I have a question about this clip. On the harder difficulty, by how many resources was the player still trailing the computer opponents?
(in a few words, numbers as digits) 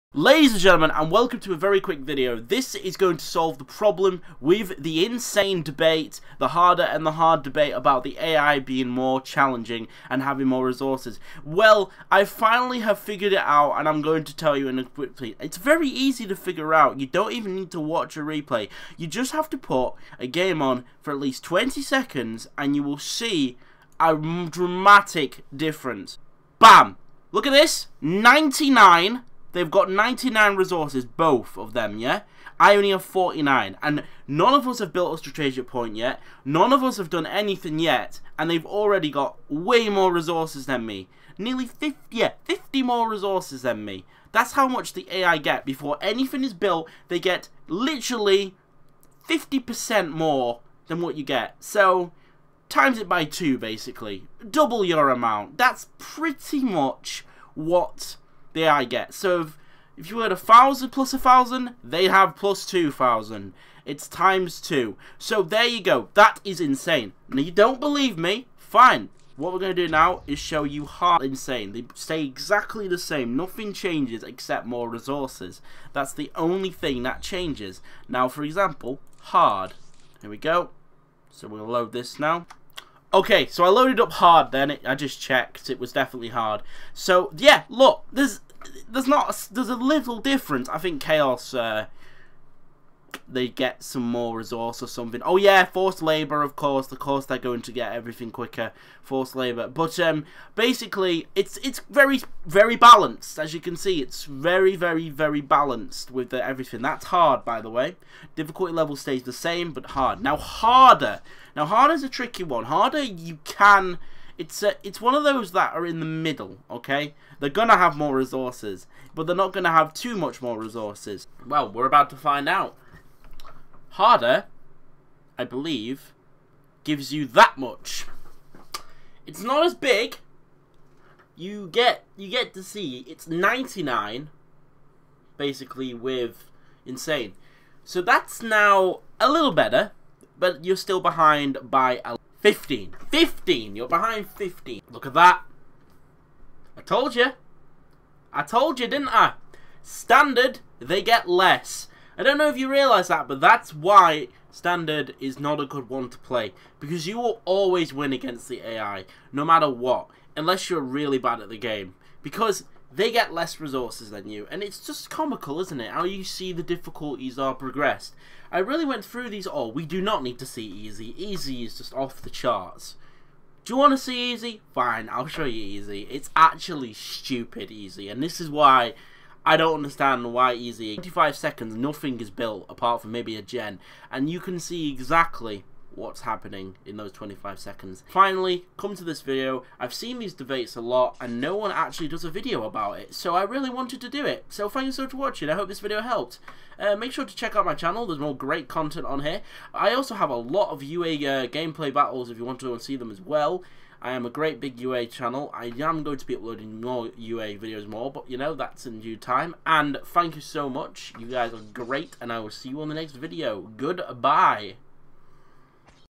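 15.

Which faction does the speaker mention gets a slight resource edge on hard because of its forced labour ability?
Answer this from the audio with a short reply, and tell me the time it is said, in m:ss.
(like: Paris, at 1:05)
Chaos, at 1:31.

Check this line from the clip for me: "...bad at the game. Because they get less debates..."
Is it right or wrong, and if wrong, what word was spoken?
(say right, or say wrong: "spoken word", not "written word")
wrong: "resources", not "debates".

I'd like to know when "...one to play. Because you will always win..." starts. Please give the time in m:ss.
2:35.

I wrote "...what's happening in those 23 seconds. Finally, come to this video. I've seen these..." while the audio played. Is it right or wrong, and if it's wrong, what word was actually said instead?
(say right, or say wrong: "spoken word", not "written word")
wrong: "25", not "23".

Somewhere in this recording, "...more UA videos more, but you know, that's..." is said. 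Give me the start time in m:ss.
3:26.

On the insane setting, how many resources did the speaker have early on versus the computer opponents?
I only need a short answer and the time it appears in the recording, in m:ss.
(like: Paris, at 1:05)
49, at 0:33.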